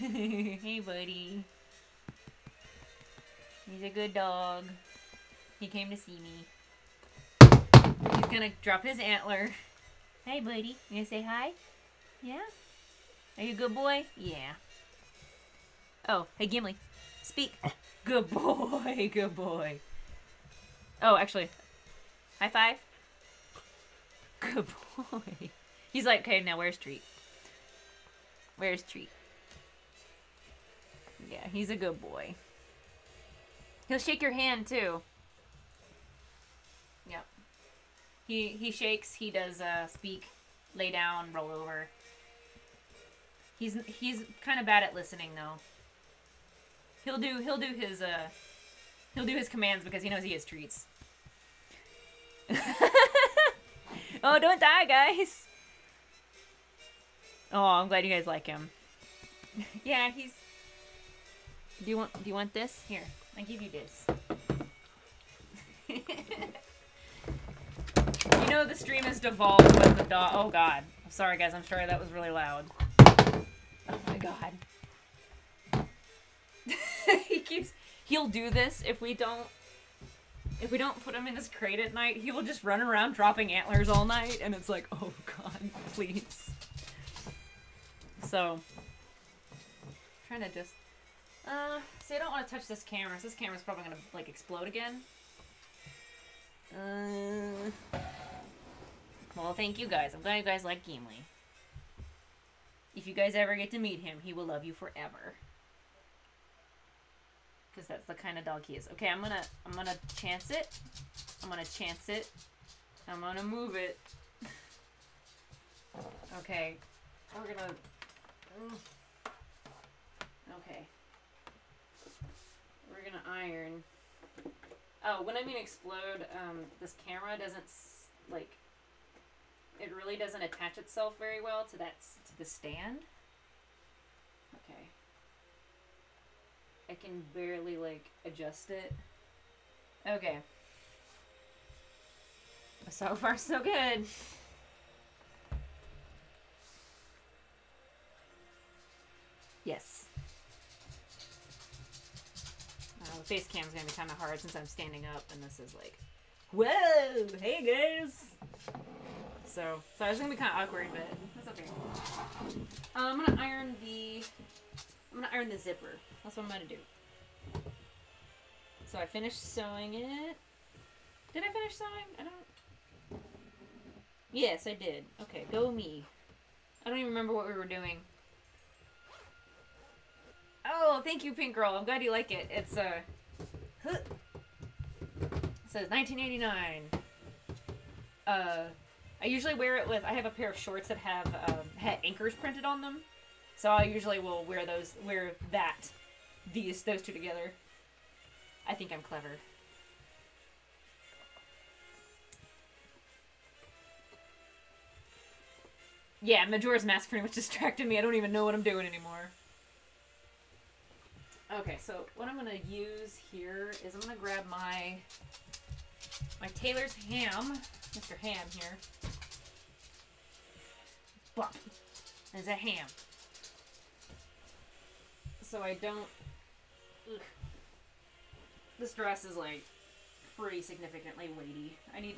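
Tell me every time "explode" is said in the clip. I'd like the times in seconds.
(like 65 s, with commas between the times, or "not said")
94 s, 125 s.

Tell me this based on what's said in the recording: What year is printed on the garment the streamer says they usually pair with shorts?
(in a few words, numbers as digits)
1989.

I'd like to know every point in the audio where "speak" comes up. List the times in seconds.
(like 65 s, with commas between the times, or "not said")
17 s, 39 s.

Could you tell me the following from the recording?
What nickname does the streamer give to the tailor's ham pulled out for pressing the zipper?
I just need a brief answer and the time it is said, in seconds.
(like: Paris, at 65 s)
Mr. Ham, at 217 s.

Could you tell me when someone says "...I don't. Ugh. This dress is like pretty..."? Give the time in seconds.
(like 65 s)
225 s.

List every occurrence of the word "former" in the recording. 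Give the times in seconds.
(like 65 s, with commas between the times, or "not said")
not said.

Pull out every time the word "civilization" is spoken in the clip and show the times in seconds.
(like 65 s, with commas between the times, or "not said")
not said.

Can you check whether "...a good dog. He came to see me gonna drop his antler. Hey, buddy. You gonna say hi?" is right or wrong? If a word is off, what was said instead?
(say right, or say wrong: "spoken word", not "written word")
right.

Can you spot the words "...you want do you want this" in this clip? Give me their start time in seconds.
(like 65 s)
61 s.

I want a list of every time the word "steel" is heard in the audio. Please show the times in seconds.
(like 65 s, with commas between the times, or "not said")
not said.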